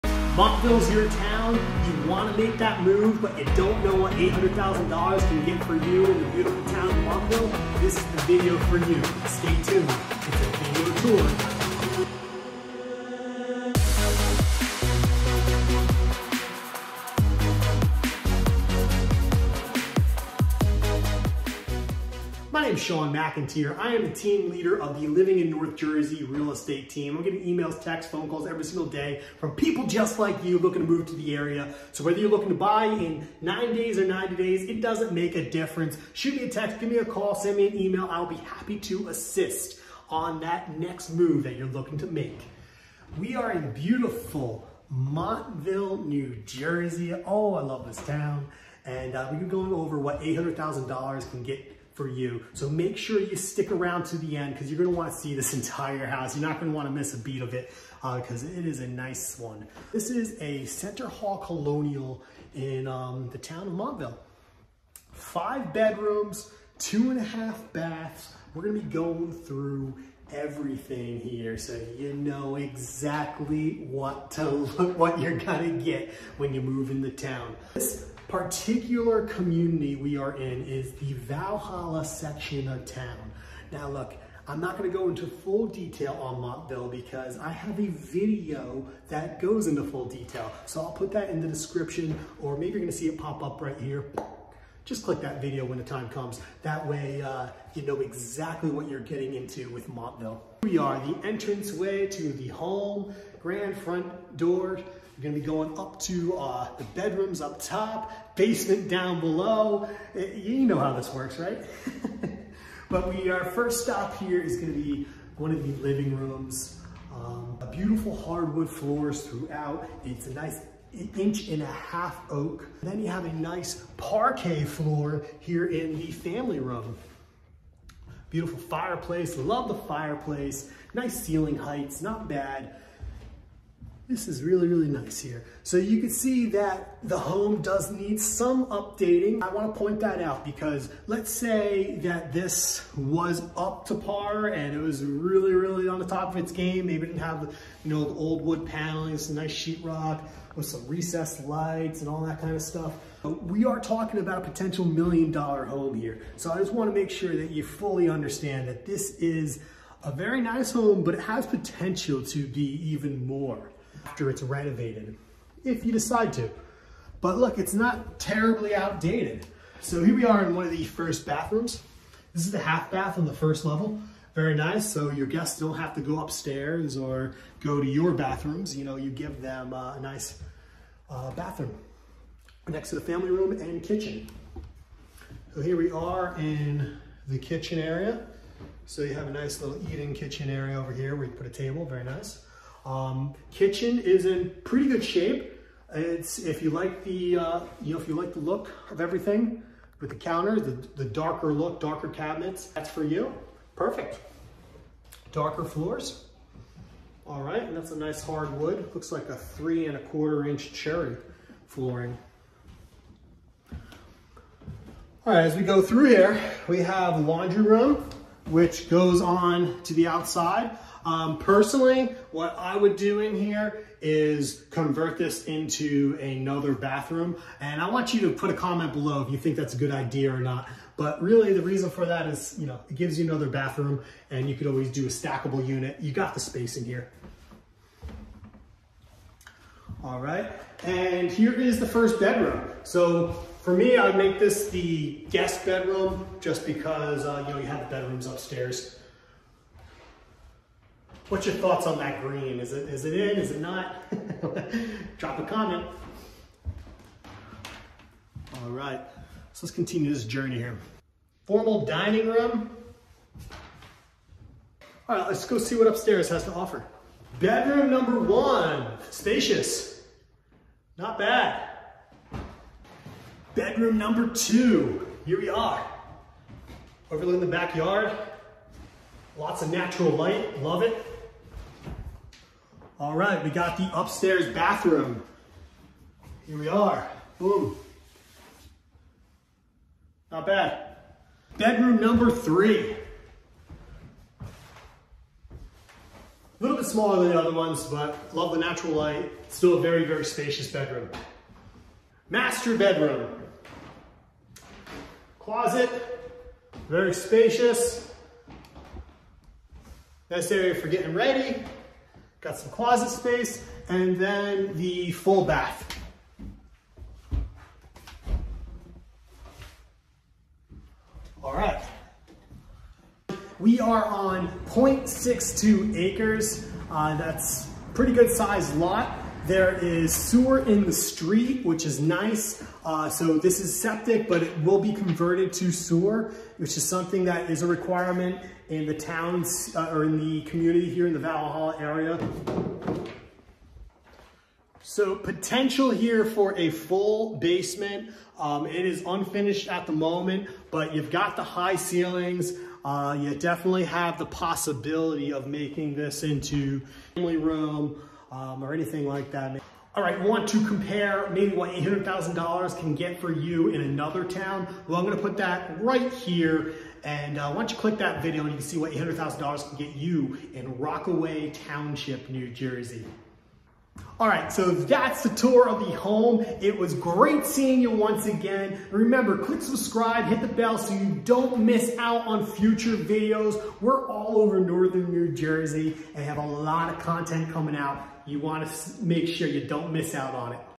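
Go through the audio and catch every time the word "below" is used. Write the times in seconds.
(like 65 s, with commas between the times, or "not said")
109 s, 228 s.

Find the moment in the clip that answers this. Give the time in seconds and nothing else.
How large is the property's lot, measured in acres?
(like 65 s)
324 s.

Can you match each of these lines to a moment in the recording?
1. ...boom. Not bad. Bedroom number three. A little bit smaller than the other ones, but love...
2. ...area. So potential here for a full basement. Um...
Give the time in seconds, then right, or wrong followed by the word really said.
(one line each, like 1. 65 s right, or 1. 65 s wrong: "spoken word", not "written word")
1. 287 s right
2. 341 s right.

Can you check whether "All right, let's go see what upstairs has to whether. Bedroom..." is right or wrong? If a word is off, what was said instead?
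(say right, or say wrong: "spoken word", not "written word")
wrong: "offer", not "whether".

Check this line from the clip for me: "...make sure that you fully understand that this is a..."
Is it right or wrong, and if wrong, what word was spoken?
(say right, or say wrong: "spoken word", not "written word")
right.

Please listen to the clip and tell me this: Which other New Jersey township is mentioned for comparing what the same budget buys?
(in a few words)
Rockaway Township.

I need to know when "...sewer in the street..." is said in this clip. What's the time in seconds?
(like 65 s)
330 s.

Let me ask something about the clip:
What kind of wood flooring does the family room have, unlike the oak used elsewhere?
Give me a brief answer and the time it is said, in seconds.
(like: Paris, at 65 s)
Parquet, at 123 s.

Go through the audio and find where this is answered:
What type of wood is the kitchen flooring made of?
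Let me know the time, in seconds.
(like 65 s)
210 s.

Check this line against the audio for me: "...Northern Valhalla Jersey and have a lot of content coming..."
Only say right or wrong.
wrong.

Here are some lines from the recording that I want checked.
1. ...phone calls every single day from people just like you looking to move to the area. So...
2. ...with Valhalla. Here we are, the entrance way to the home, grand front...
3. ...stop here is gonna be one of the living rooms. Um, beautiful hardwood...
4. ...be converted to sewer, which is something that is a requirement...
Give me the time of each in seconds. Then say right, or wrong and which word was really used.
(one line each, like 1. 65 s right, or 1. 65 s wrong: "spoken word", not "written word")
1. 28 s right
2. 99 s wrong: "Montville", not "Valhalla"
3. 113 s right
4. 334 s right.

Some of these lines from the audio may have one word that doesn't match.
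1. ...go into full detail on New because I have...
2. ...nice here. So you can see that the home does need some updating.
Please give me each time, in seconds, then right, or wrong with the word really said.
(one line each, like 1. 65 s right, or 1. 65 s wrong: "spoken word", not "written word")
1. 84 s wrong: "Montville", not "New"
2. 134 s right.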